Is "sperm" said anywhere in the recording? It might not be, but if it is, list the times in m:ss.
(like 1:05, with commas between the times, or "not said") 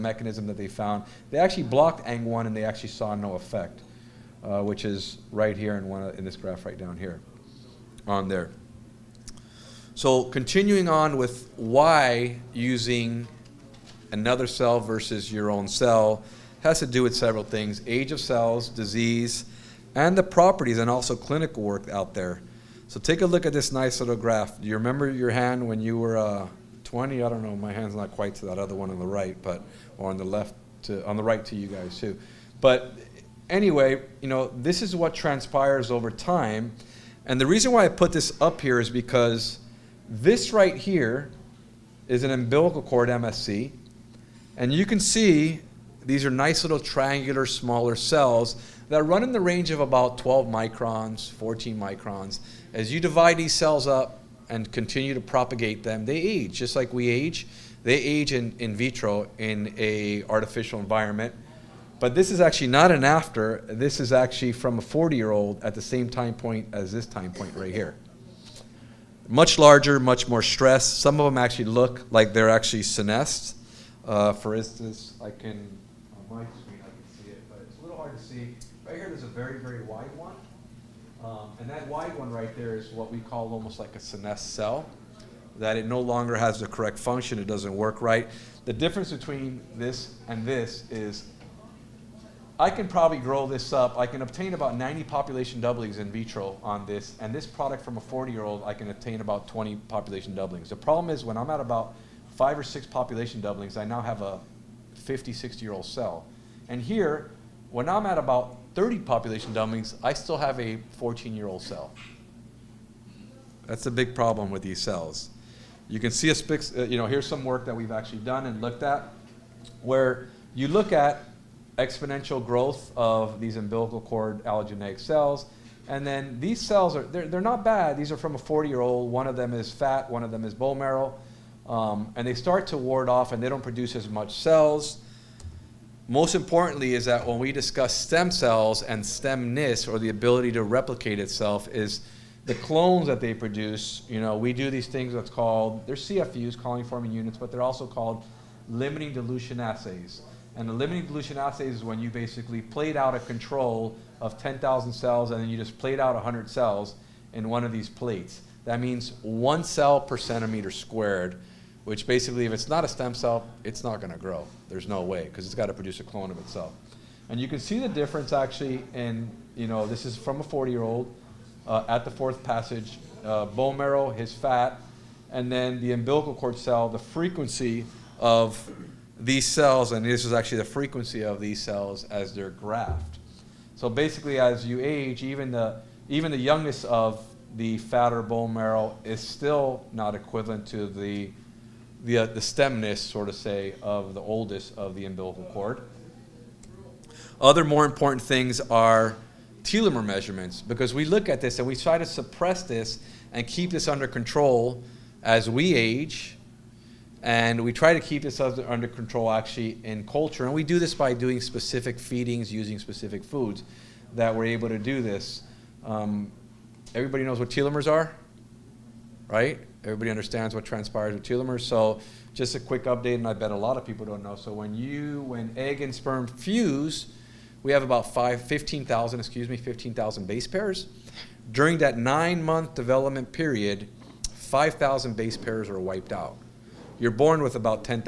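3:45.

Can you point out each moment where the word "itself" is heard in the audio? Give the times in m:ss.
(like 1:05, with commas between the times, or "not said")
2:21, 2:46.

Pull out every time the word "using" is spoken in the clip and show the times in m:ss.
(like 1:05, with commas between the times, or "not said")
0:12, 3:32.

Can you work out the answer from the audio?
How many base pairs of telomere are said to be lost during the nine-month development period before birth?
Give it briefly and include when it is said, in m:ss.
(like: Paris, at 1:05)
5,000, at 3:54.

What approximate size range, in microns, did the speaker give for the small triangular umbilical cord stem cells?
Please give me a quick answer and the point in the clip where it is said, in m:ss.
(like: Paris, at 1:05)
12 to 14 microns, at 0:50.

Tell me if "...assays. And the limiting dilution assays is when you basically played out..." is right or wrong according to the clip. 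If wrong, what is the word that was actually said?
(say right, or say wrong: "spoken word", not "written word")
right.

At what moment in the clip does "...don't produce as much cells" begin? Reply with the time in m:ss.
2:13.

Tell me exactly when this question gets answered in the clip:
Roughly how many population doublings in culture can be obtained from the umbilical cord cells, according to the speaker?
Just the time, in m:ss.
1:34.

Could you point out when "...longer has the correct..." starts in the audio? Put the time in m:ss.
1:26.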